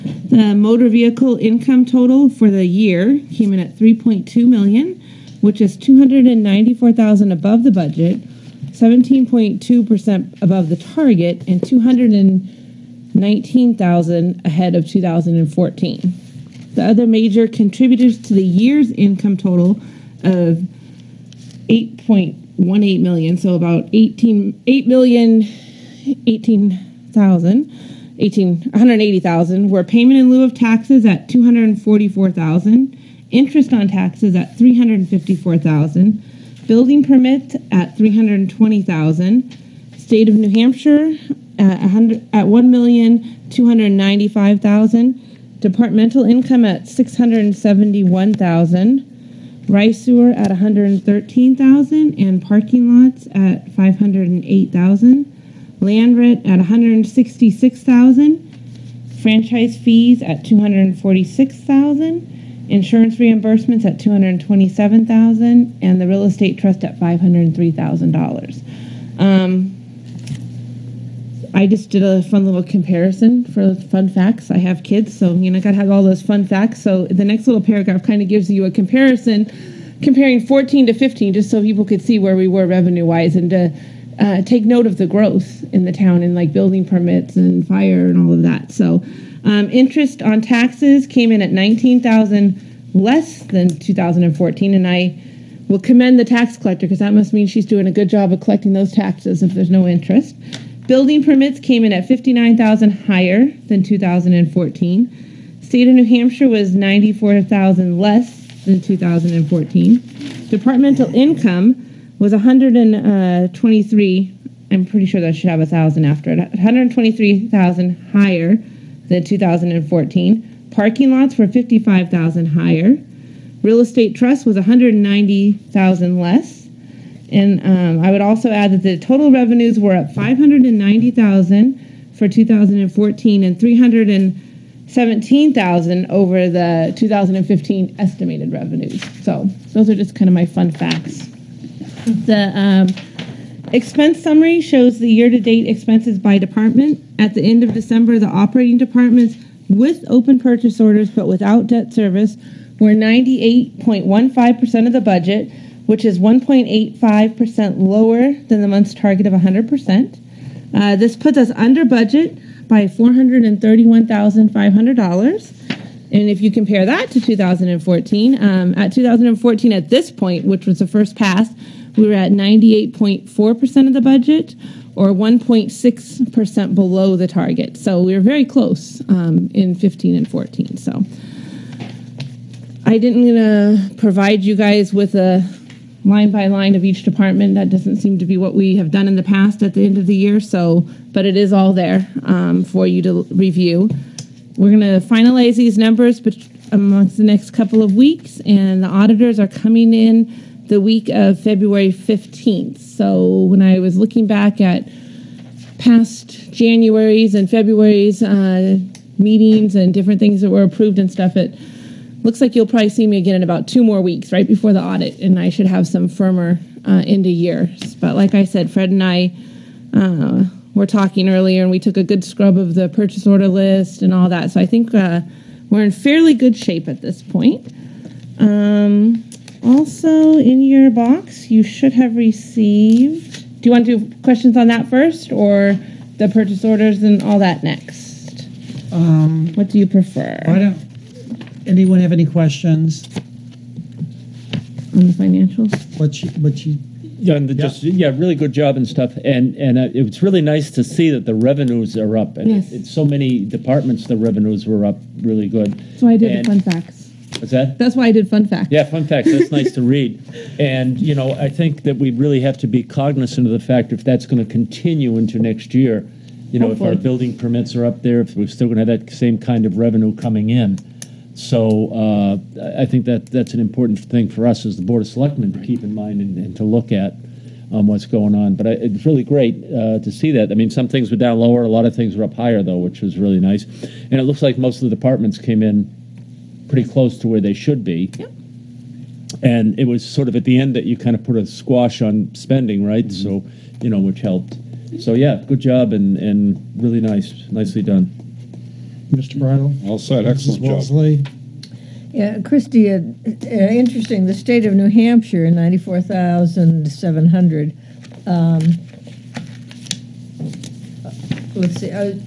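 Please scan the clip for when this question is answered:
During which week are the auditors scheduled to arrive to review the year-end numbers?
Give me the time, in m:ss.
3:20.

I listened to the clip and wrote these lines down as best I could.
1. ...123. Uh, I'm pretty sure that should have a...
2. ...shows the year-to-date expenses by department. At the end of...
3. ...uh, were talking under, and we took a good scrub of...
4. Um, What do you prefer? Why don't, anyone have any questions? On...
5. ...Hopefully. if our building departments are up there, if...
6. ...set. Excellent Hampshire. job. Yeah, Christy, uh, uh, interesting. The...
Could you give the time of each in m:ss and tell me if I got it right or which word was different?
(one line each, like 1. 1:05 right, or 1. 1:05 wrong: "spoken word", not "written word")
1. 1:52 right
2. 2:24 right
3. 3:39 wrong: "earlier", not "under"
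4. 3:58 right
5. 4:26 wrong: "permits", not "departments"
6. 4:59 wrong: "Mrs", not "Hampshire".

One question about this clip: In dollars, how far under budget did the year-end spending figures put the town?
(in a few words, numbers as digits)
$431,500.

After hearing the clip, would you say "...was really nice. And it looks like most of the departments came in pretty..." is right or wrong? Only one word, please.
right.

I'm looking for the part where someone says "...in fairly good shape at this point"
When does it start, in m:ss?
3:45.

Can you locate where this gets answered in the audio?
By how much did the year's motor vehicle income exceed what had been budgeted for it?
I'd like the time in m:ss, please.
0:05.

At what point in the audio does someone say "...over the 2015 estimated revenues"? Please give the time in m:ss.
2:16.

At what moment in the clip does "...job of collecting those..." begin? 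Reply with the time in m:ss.
1:38.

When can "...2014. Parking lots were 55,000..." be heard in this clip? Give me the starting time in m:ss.
1:59.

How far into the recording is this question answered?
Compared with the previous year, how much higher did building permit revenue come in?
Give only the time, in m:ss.
1:42.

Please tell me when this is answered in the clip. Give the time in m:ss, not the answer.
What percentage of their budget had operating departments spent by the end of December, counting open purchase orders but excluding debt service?
2:32.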